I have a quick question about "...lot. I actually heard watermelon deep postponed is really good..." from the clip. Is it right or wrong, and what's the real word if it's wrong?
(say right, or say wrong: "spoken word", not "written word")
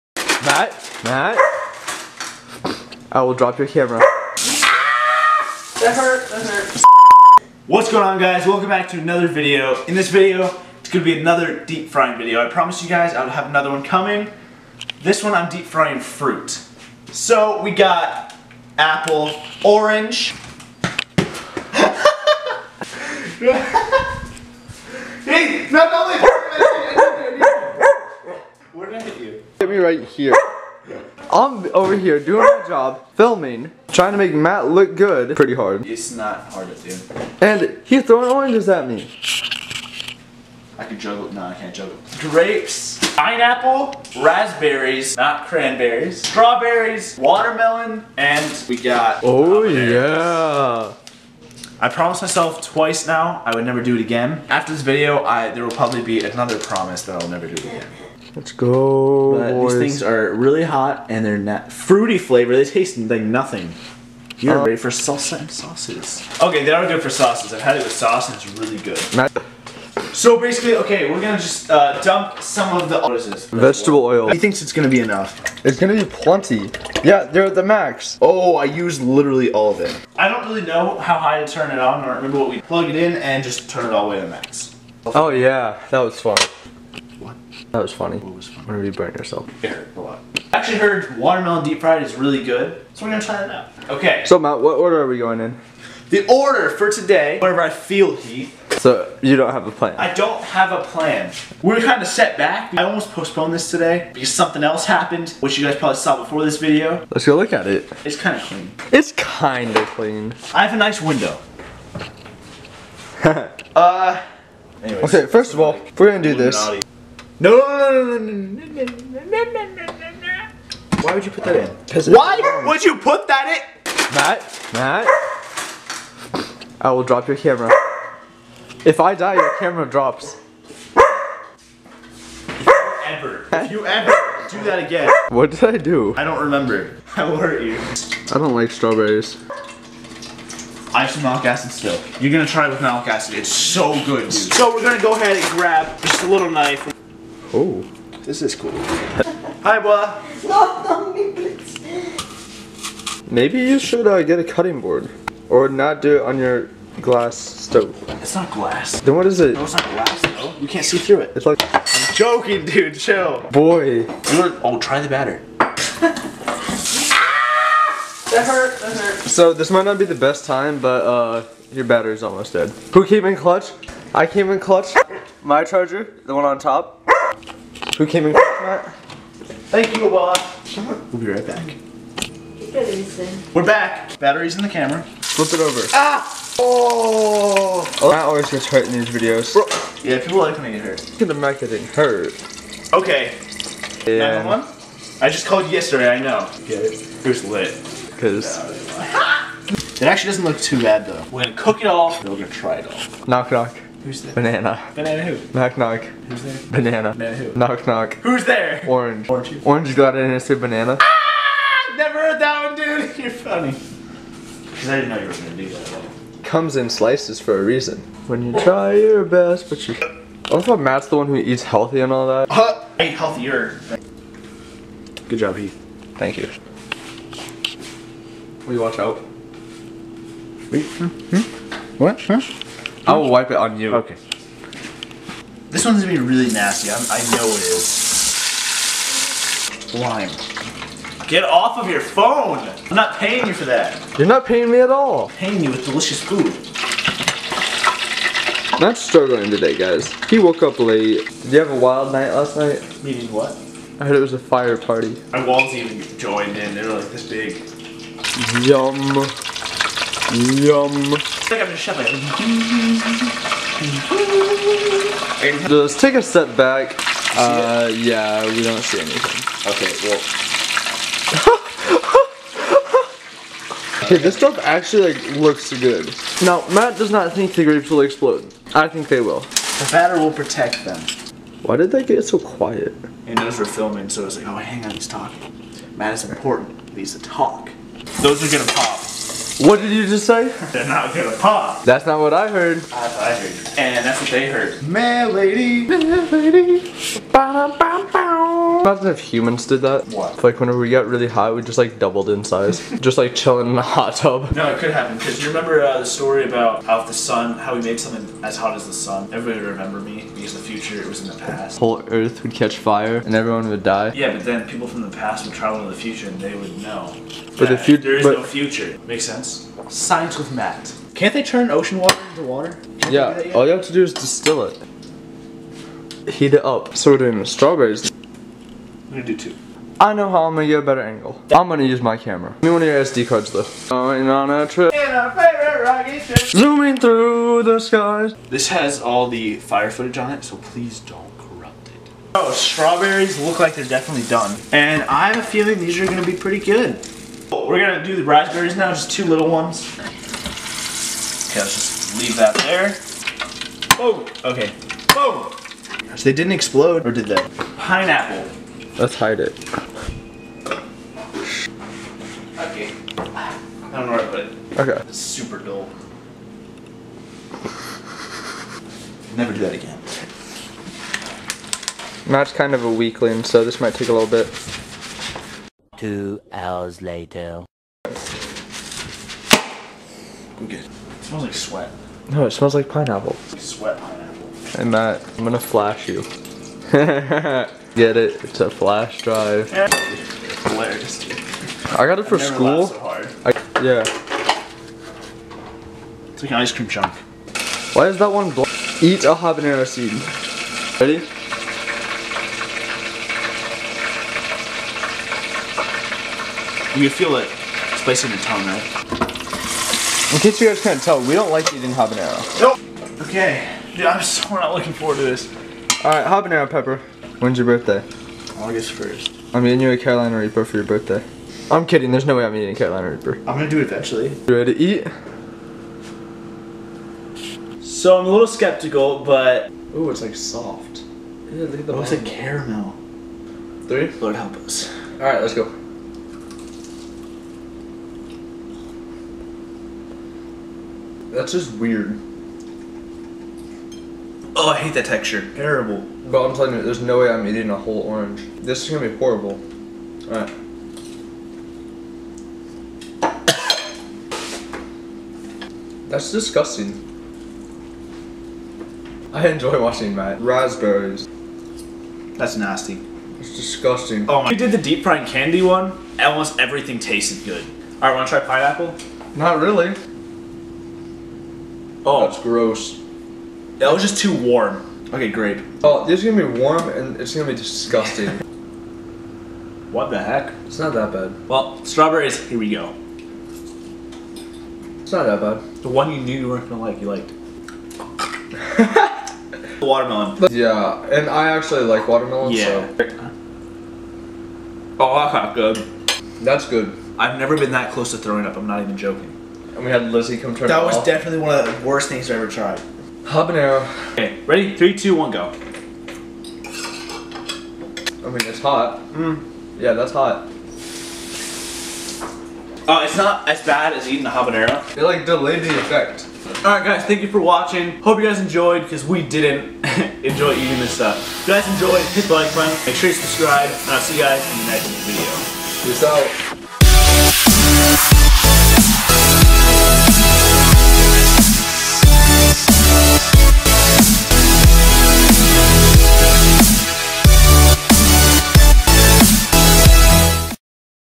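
wrong: "fried", not "postponed".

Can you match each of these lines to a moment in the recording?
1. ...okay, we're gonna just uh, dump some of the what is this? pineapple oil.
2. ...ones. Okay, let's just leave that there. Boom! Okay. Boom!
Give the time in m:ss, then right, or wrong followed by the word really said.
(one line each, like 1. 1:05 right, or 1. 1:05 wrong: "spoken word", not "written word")
1. 1:10 wrong: "vegetable", not "pineapple"
2. 5:49 right.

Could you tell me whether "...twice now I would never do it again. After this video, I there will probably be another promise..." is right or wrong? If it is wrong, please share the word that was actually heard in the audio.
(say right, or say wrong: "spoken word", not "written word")
right.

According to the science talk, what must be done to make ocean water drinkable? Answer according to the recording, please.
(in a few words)
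Distill it.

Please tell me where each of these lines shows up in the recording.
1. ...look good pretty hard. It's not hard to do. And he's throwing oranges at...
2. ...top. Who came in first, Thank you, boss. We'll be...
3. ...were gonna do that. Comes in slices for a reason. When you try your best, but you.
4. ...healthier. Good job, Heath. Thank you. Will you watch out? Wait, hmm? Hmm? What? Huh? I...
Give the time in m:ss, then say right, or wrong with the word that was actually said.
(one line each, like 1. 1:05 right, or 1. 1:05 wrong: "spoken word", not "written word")
1. 0:34 right
2. 2:56 right
3. 3:35 right
4. 3:43 right.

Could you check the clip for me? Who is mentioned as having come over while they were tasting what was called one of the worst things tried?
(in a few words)
Lizzie.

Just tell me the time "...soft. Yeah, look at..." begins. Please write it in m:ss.
7:10.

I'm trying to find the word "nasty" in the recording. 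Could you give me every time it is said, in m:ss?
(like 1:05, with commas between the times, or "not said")
3:56, 7:42.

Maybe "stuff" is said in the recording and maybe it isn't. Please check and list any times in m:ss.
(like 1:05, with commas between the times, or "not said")
4:34, 8:40.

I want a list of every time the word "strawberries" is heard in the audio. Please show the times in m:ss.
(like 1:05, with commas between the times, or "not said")
0:46, 2:18, 5:27, 5:42, 8:01.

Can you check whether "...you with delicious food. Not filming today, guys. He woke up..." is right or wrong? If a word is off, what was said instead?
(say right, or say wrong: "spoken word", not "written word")
wrong: "struggling", not "filming".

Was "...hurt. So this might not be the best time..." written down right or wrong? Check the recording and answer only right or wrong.
right.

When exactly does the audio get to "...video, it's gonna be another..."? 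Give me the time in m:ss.
0:10.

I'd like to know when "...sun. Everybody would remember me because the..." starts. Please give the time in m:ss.
5:08.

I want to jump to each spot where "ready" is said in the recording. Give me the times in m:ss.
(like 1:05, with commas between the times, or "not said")
1:04, 6:40, 7:04, 8:24.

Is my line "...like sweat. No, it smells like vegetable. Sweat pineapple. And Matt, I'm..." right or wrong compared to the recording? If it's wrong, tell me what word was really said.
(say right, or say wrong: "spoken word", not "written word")
wrong: "pineapple", not "vegetable".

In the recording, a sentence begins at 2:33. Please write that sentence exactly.
Maybe you should uh, get a cutting board.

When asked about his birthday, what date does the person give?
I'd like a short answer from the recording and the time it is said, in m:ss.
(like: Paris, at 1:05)
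August 1st, at 6:58.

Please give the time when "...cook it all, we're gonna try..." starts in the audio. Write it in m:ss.
3:21.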